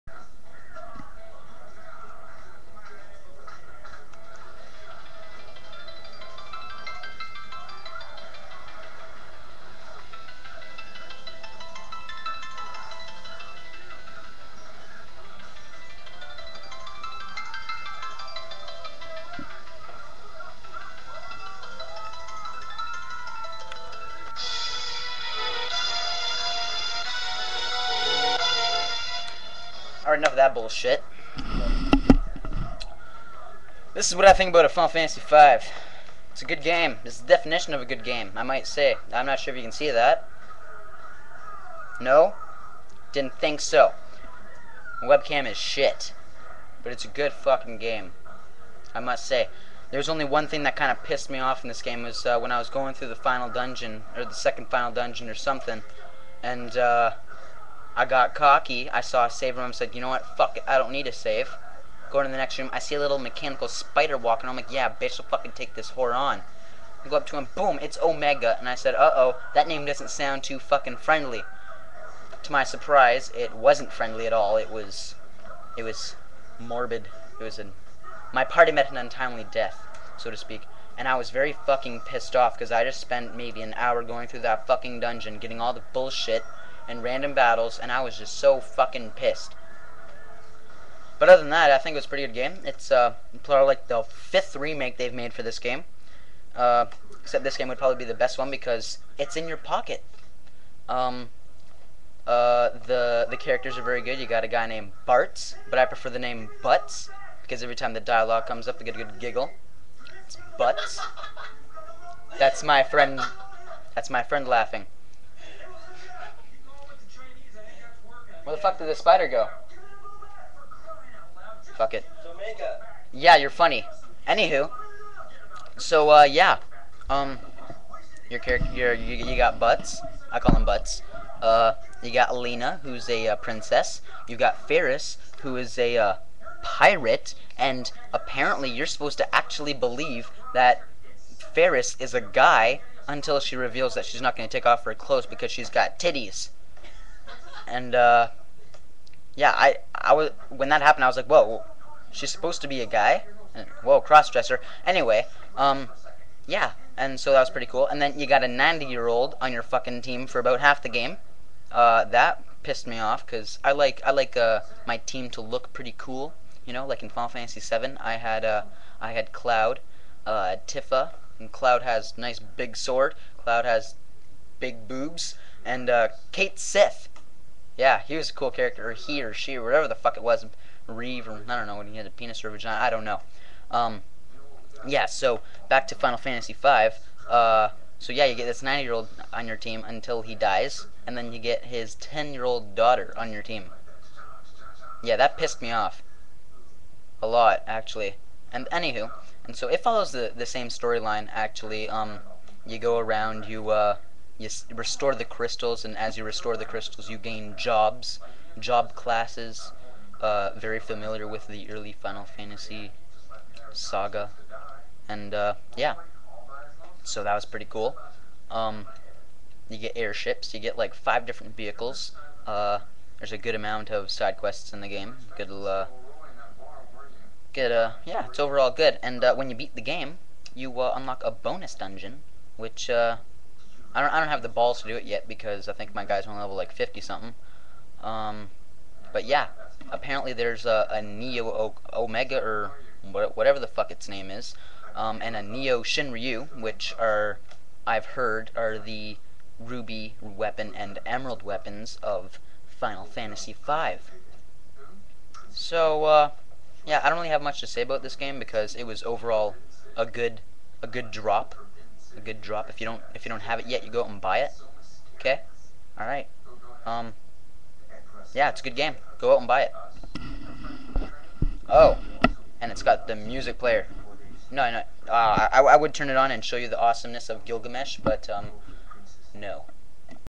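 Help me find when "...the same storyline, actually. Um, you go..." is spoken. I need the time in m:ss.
3:20.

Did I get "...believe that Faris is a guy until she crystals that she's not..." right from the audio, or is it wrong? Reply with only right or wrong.
wrong.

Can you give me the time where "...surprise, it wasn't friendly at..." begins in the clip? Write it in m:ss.
1:12.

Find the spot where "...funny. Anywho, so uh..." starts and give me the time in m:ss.
2:03.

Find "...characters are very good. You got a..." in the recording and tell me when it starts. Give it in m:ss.
1:43.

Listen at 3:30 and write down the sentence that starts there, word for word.
Uh, very familiar with the early Final Fantasy saga, and uh, yeah, so that was pretty cool.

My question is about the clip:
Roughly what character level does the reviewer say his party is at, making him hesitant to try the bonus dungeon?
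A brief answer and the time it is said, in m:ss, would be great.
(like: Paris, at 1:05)
50 something, at 3:56.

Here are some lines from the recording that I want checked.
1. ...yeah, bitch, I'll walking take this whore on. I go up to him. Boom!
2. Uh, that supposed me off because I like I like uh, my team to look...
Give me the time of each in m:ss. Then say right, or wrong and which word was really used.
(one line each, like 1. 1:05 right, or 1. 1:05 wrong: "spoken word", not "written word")
1. 1:04 wrong: "fucking", not "walking"
2. 2:41 wrong: "pissed", not "supposed".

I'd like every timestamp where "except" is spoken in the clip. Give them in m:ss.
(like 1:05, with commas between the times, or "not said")
1:37.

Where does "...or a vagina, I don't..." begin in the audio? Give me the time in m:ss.
3:02.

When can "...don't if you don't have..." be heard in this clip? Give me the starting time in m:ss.
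4:22.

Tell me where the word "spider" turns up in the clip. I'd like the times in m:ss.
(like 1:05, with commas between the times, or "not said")
1:03, 1:58.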